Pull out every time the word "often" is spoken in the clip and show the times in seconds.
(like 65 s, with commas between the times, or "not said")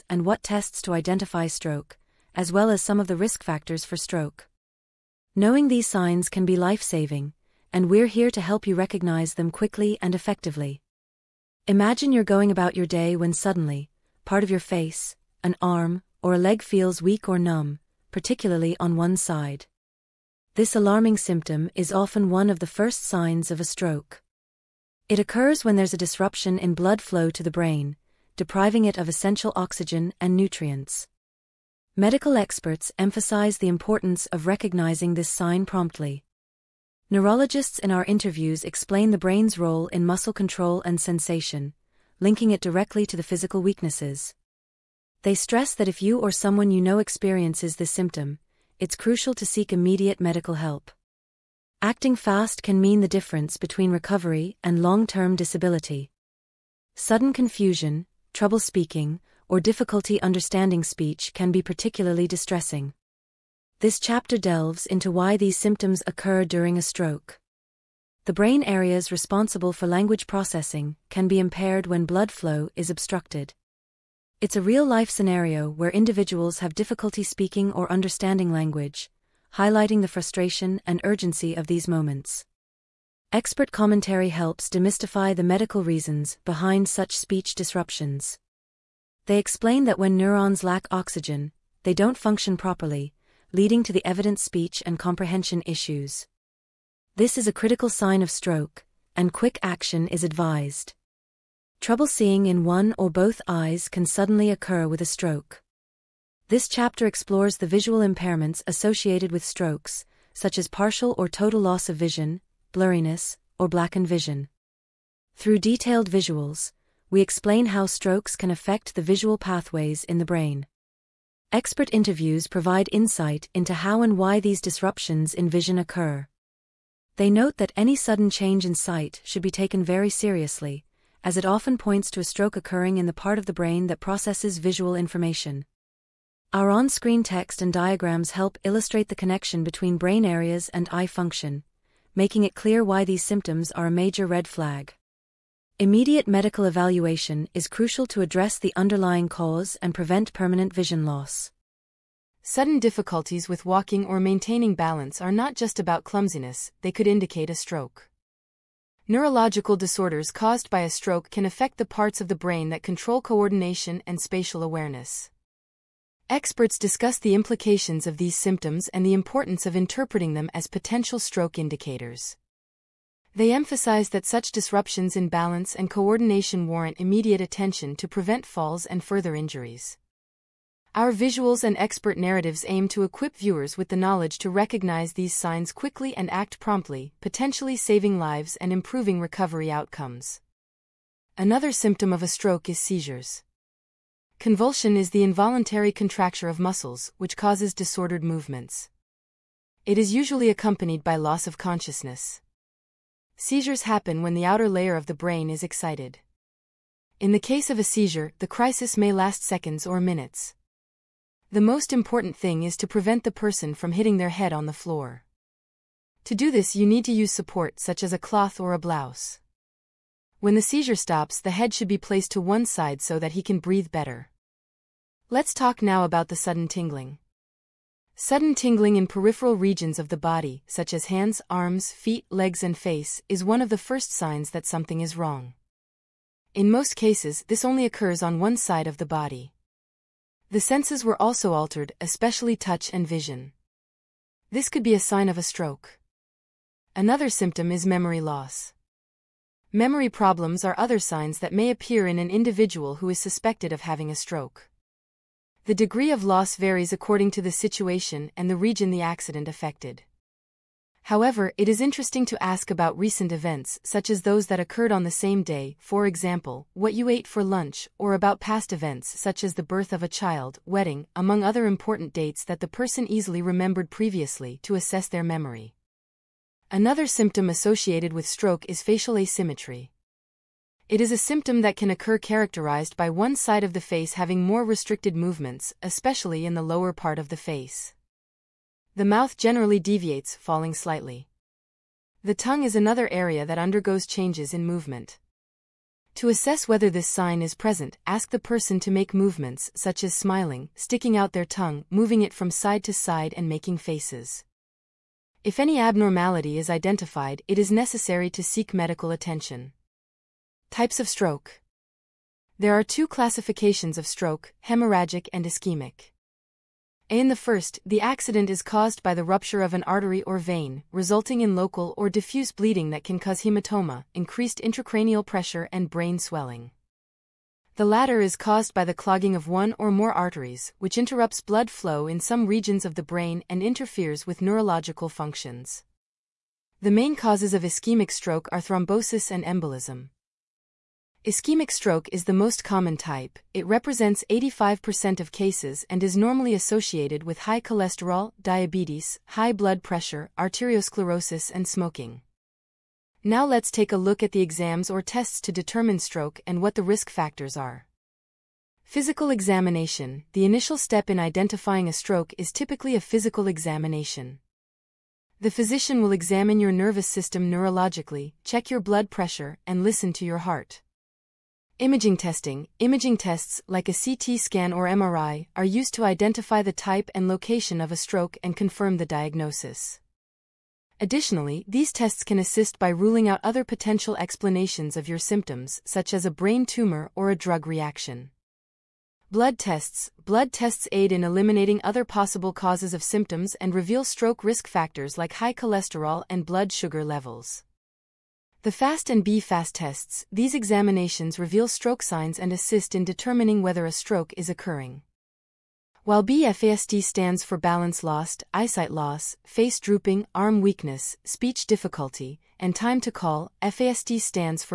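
21 s, 131 s.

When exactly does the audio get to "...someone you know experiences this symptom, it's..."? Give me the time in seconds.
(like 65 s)
46 s.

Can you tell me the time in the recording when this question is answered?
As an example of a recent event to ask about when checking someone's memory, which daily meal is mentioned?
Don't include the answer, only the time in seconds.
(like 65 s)
267 s.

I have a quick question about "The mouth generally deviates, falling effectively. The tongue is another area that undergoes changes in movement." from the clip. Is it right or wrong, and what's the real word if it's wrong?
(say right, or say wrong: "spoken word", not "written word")
wrong: "slightly", not "effectively".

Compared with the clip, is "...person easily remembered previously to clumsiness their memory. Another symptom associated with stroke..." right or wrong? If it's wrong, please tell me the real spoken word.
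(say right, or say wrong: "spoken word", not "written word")
wrong: "assess", not "clumsiness".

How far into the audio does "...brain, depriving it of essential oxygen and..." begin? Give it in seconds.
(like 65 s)
27 s.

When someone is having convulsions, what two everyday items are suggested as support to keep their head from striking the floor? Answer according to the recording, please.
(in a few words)
a cloth or a blouse.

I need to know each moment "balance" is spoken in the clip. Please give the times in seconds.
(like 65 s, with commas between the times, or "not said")
154 s, 175 s, 407 s.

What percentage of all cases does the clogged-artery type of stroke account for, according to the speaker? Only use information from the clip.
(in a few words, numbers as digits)
85%.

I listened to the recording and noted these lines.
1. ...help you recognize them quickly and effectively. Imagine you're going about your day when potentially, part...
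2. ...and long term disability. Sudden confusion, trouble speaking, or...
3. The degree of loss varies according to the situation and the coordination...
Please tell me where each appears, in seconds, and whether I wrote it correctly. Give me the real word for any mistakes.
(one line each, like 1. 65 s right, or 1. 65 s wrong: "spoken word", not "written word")
1. 8 s wrong: "suddenly", not "potentially"
2. 54 s right
3. 255 s wrong: "region", not "coordination".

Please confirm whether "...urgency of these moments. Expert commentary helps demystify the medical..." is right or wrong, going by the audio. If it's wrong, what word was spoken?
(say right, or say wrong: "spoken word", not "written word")
right.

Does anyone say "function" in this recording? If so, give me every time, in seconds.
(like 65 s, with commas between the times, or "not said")
92 s, 141 s, 335 s.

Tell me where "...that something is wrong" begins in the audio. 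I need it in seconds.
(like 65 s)
234 s.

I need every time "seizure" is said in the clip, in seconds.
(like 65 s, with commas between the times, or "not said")
192 s, 203 s, 207 s, 220 s.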